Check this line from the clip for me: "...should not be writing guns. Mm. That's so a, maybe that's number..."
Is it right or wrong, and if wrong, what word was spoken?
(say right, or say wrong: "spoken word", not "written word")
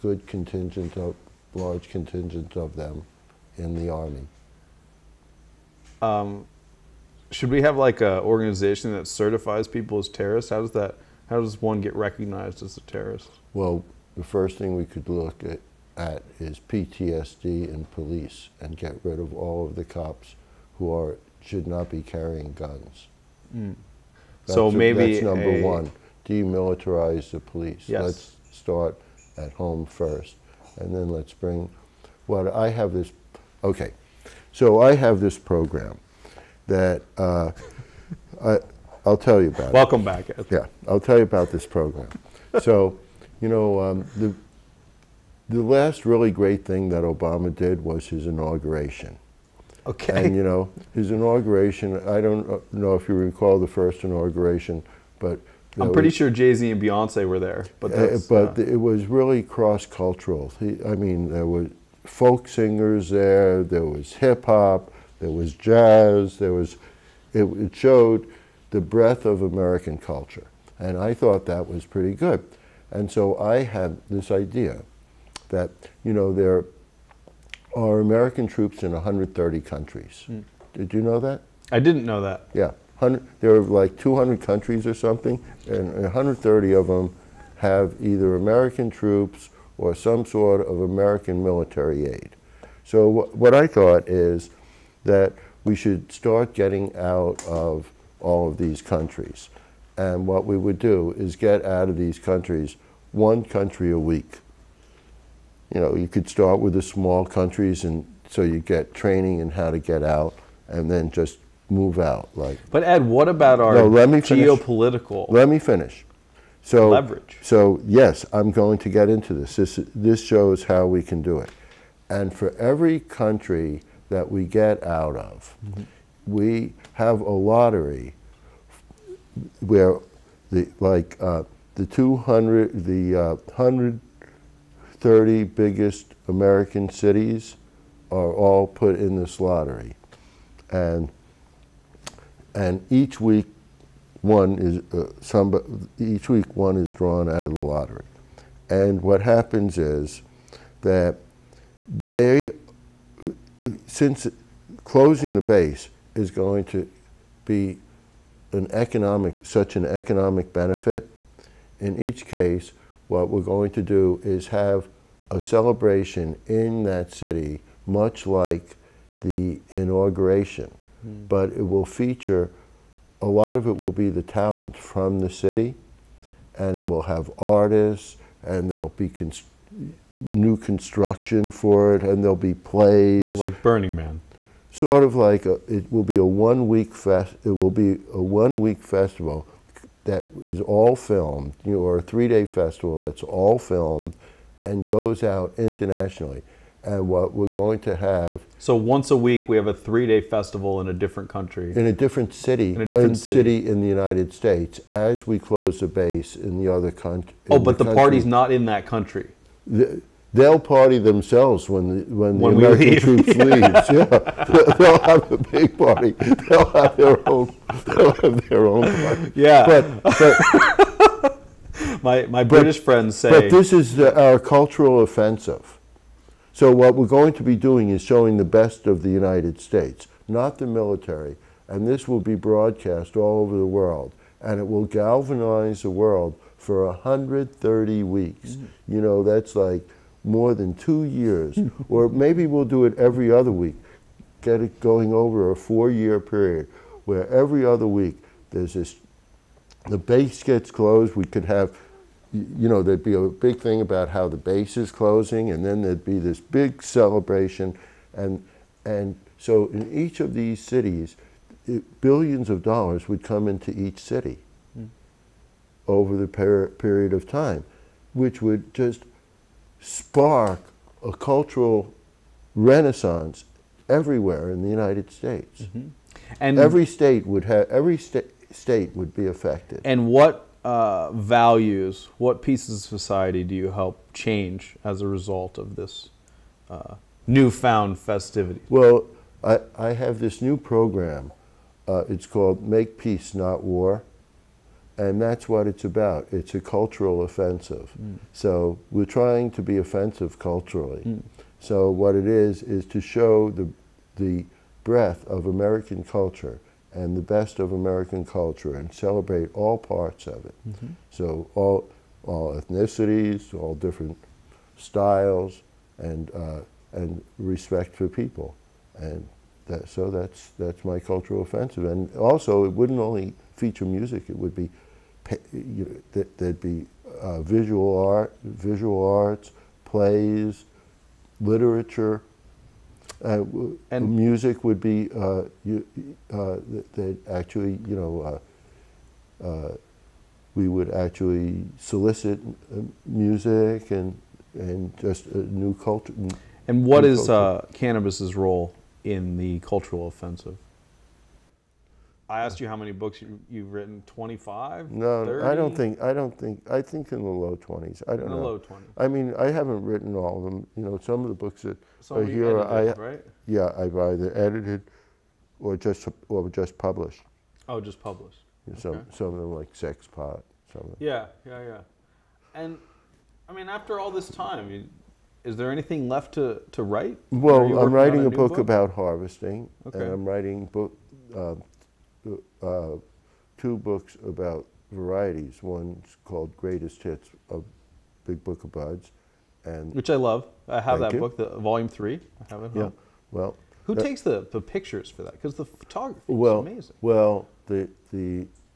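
wrong: "carrying", not "writing".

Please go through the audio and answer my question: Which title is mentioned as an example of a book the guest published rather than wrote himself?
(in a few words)
Sex Pot.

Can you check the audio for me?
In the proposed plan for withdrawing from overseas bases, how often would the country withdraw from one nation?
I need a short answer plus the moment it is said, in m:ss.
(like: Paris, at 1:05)
one country a week, at 1:43.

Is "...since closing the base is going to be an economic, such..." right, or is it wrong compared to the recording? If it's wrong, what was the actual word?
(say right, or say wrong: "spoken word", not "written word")
right.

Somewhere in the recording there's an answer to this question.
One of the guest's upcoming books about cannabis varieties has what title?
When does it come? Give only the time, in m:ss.
6:26.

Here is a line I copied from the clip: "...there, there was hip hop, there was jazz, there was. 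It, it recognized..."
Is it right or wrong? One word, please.
wrong.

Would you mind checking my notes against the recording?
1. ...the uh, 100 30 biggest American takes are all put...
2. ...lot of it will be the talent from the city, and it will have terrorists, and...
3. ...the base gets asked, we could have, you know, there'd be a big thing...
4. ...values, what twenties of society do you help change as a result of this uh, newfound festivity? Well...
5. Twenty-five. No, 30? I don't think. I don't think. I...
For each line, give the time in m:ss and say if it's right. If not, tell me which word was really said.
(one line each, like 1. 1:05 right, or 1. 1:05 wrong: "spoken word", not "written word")
1. 2:12 wrong: "cities", not "takes"
2. 2:53 wrong: "artists", not "terrorists"
3. 4:09 wrong: "closed", not "asked"
4. 4:41 wrong: "pieces", not "twenties"
5. 5:54 right.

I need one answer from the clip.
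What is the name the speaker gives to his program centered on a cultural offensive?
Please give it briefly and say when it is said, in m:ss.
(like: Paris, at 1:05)
Make Peace, Not War, at 4:52.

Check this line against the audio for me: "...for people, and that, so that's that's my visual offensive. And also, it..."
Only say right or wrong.
wrong.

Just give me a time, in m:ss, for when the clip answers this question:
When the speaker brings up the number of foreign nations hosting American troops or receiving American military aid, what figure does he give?
1:18.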